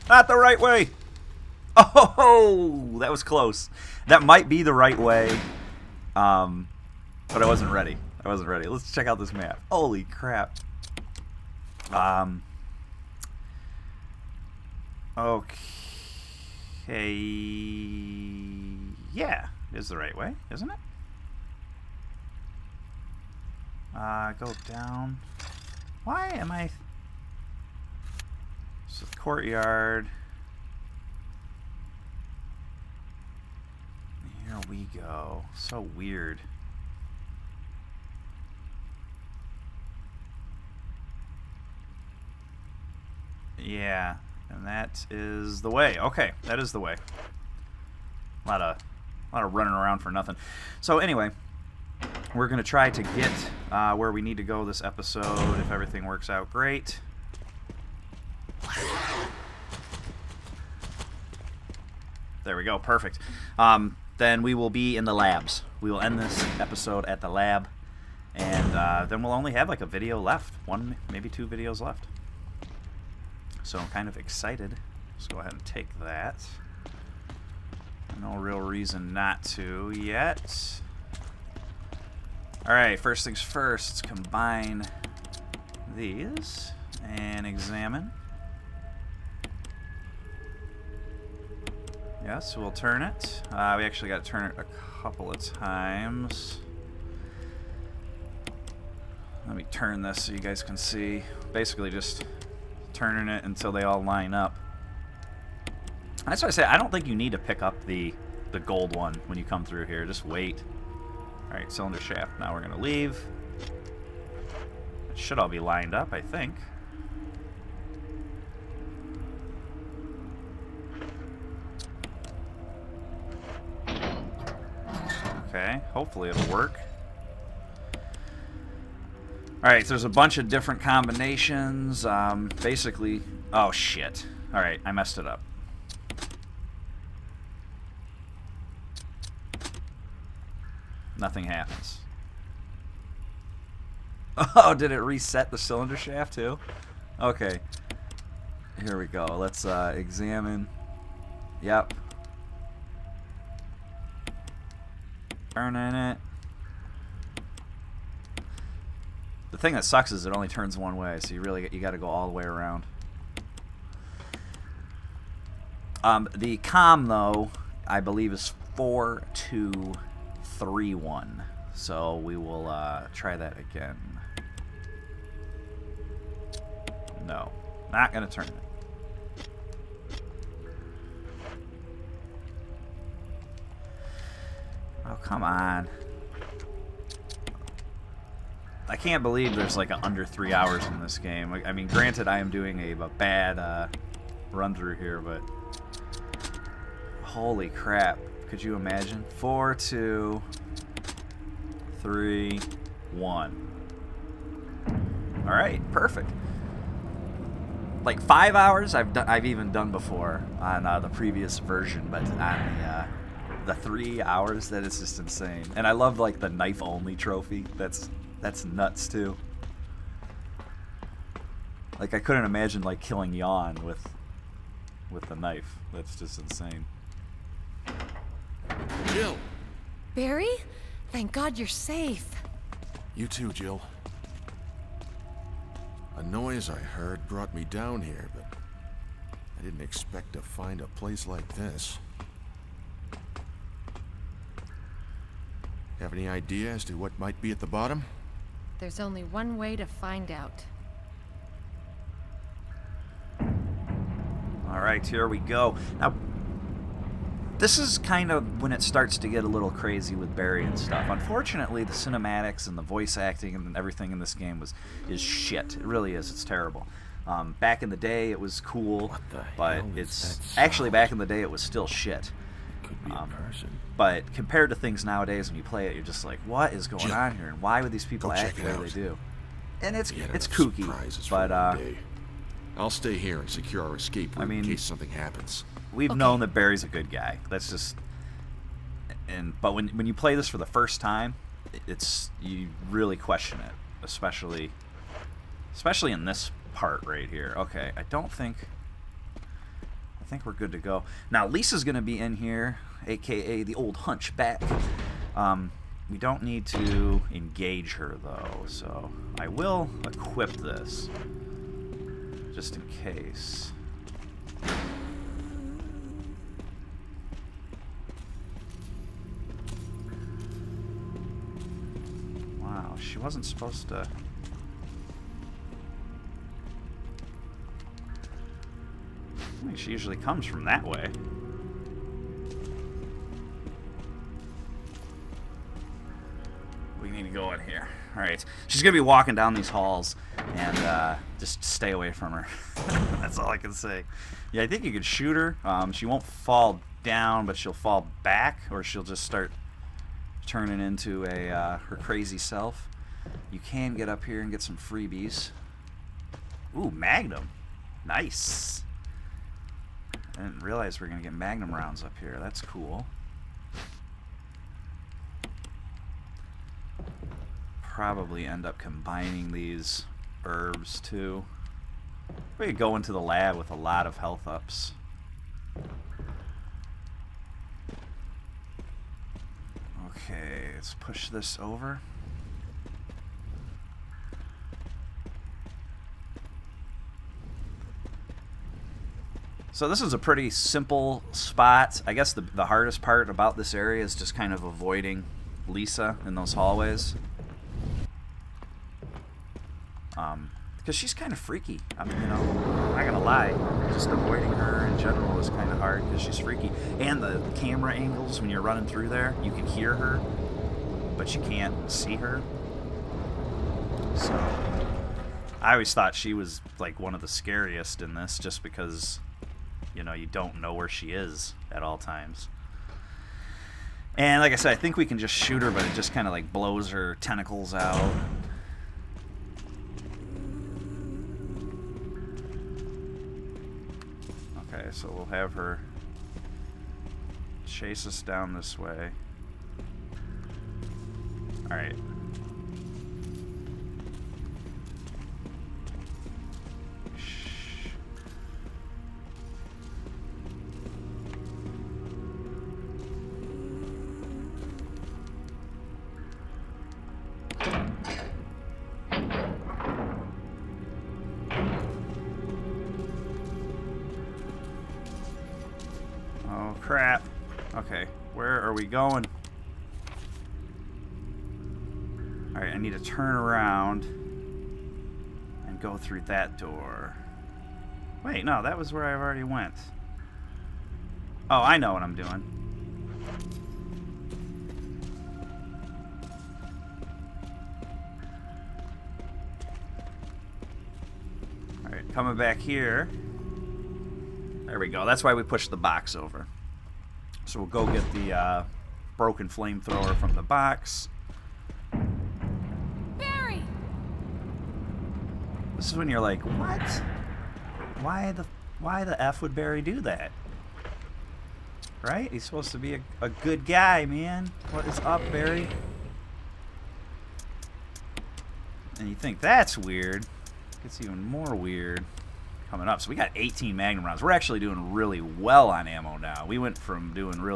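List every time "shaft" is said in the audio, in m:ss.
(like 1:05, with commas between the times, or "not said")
1:52, 2:25.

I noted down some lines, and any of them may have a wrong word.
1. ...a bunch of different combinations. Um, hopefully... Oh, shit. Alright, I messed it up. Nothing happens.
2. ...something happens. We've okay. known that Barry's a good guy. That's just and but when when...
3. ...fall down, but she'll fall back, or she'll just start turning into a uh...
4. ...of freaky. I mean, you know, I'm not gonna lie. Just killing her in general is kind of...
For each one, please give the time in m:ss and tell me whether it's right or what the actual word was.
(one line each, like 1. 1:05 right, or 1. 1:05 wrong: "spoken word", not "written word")
1. 2:10 wrong: "basically", not "hopefully"
2. 4:44 right
3. 5:46 right
4. 6:41 wrong: "avoiding", not "killing".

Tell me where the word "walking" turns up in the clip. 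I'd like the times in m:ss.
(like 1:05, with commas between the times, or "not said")
5:39.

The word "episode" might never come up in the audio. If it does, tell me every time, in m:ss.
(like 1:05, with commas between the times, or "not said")
0:54, 1:06.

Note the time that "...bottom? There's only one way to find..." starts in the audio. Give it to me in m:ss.
4:07.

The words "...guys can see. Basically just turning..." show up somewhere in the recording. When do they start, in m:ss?
1:40.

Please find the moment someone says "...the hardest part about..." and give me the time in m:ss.
6:32.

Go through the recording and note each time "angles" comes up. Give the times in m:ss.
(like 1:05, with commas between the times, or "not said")
6:47.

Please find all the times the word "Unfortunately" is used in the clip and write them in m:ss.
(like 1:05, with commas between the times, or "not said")
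4:21.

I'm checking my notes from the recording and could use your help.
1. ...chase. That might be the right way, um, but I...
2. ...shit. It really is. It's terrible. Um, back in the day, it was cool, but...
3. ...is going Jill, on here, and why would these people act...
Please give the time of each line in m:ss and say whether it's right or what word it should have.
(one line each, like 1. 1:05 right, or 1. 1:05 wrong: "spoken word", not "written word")
1. 0:03 wrong: "close", not "chase"
2. 4:25 right
3. 4:36 wrong: "Jim", not "Jill".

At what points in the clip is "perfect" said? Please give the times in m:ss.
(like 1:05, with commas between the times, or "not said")
1:02, 3:25.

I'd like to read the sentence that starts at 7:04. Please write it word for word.
And like I said, I think we can just shoot her, but it just kind of like blows her tentacles out.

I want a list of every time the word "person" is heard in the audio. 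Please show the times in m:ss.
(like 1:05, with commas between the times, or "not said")
4:33.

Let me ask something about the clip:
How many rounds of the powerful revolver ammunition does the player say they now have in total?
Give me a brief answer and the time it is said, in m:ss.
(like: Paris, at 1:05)
18, at 8:43.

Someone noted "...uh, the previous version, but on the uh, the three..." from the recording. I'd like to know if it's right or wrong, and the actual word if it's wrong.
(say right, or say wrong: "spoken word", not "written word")
right.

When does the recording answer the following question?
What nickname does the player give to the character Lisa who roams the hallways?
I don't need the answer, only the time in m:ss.
5:03.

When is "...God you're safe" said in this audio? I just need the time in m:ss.
3:51.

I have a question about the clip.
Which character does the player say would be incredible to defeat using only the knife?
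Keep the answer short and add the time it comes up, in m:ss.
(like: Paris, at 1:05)
Yawn, at 3:43.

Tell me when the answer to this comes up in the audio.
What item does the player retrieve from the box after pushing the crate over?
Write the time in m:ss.
8:19.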